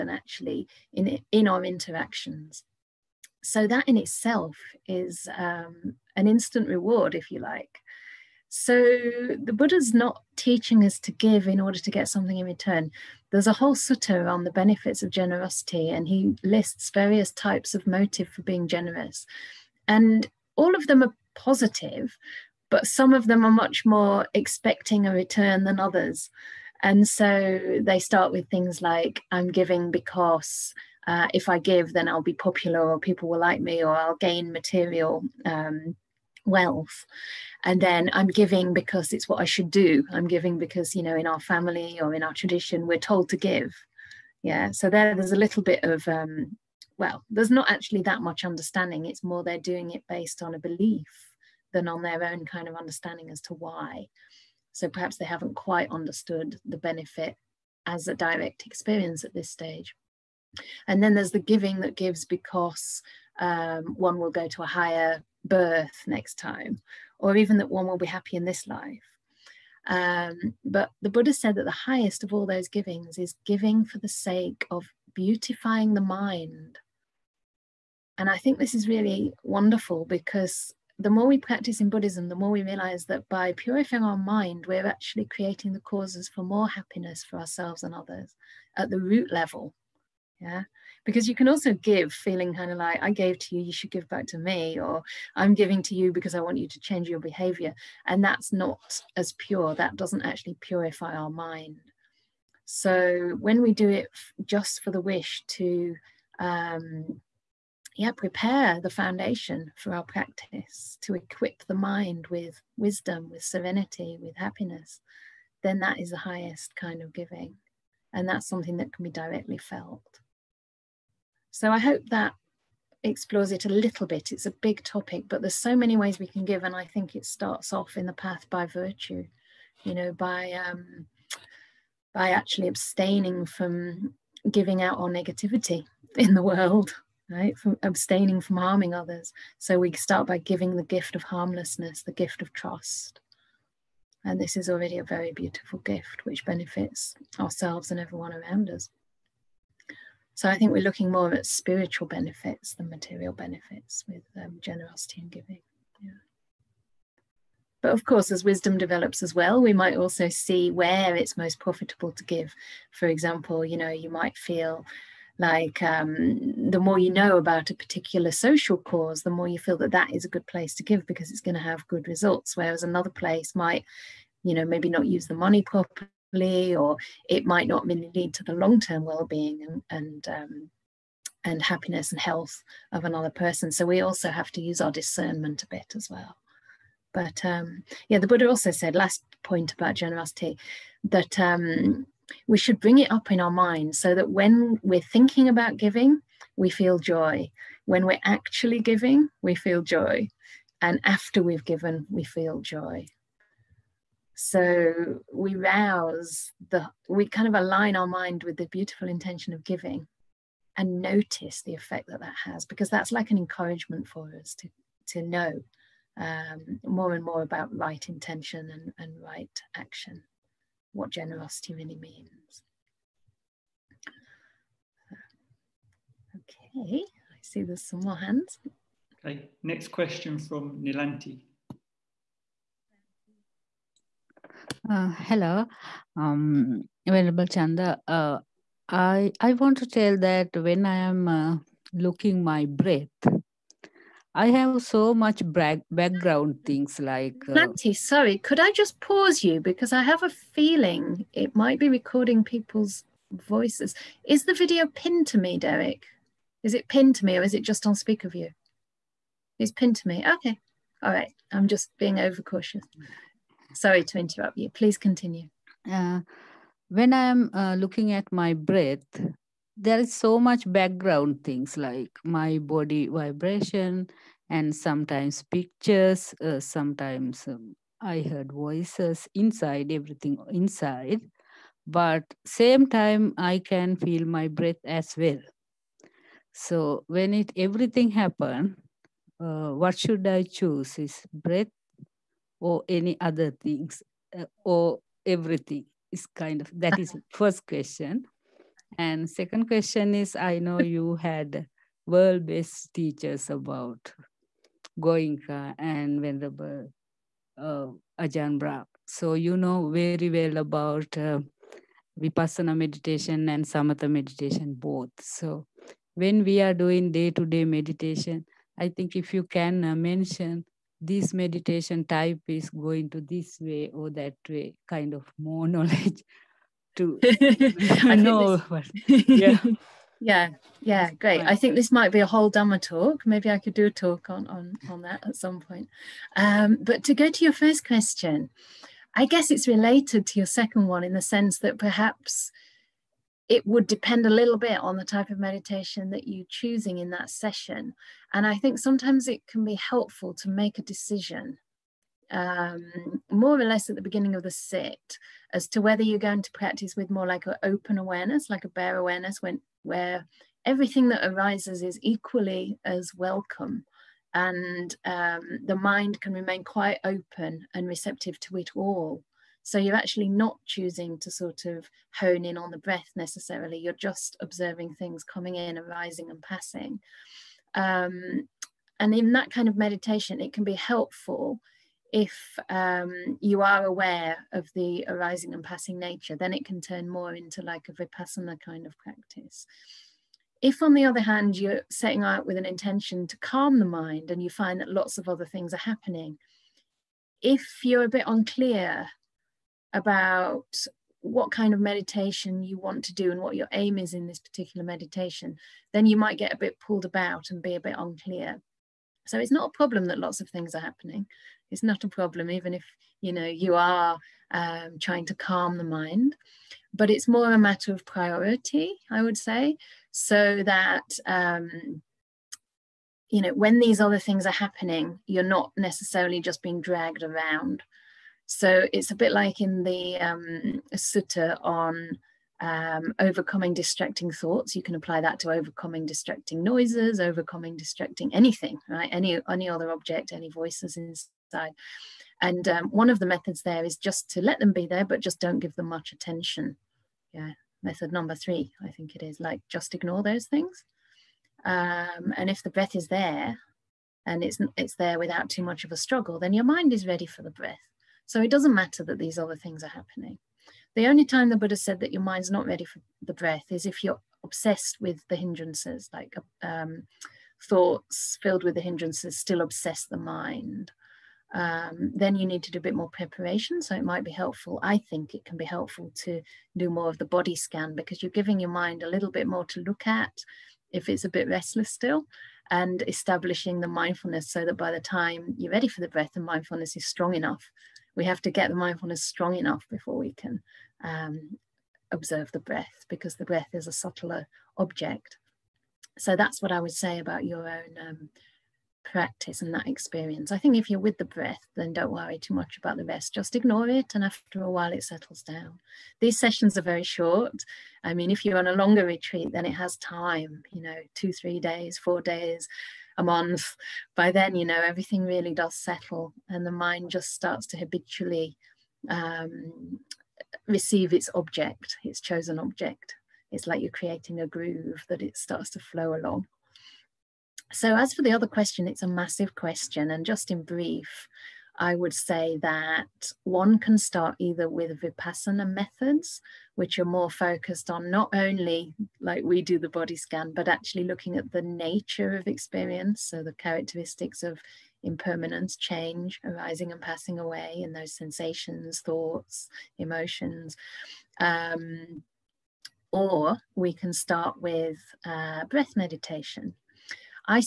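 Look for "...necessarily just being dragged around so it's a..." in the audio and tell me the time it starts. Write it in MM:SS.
07:05.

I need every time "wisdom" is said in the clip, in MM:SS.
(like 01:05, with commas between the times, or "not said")
01:52, 02:38.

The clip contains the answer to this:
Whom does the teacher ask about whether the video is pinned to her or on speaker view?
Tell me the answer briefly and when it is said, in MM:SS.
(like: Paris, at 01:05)
Derek, at 04:15.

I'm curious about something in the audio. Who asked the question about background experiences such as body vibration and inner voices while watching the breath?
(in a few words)
Nilanti.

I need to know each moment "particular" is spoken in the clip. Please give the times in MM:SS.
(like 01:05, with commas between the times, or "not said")
02:47, 06:44.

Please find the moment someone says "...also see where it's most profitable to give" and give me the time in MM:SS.
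02:39.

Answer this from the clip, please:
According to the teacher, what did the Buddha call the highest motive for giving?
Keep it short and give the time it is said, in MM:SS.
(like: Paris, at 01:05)
Beautifying the mind, at 01:15.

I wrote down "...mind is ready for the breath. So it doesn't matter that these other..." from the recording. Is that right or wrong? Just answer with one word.
right.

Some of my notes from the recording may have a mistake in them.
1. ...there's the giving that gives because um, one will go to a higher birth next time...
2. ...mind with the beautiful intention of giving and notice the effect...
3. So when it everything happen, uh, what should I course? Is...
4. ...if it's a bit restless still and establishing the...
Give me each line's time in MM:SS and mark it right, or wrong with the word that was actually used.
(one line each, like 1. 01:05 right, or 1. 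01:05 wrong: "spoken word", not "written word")
1. 01:01 right
2. 03:28 right
3. 04:46 wrong: "choose", not "course"
4. 08:00 right.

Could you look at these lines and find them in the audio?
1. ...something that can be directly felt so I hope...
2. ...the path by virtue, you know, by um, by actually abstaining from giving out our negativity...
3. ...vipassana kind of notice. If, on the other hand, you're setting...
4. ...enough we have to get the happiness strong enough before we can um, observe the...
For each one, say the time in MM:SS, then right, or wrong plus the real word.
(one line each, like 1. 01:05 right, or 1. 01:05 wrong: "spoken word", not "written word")
1. 01:58 right
2. 02:08 right
3. 06:27 wrong: "practice", not "notice"
4. 08:07 wrong: "mindfulness", not "happiness".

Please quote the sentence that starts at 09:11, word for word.
Um, or we can start with uh, breath meditation.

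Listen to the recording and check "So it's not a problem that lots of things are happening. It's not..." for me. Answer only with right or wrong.
right.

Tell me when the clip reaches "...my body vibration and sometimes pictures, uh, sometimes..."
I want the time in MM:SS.
04:32.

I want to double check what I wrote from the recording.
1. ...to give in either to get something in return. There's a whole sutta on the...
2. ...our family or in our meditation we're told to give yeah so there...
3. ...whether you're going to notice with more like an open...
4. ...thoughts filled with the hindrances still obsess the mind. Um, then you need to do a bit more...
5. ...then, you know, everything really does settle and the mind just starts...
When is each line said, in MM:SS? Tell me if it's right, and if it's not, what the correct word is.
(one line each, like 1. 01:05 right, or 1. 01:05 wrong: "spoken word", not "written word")
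1. 00:10 wrong: "order", not "either"
2. 00:41 wrong: "tradition", not "meditation"
3. 05:55 wrong: "practice", not "notice"
4. 07:47 right
5. 08:34 right.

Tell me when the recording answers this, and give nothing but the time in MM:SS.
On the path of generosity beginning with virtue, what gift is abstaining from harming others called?
02:21.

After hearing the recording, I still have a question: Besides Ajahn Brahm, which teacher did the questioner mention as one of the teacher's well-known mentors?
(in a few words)
Goenka.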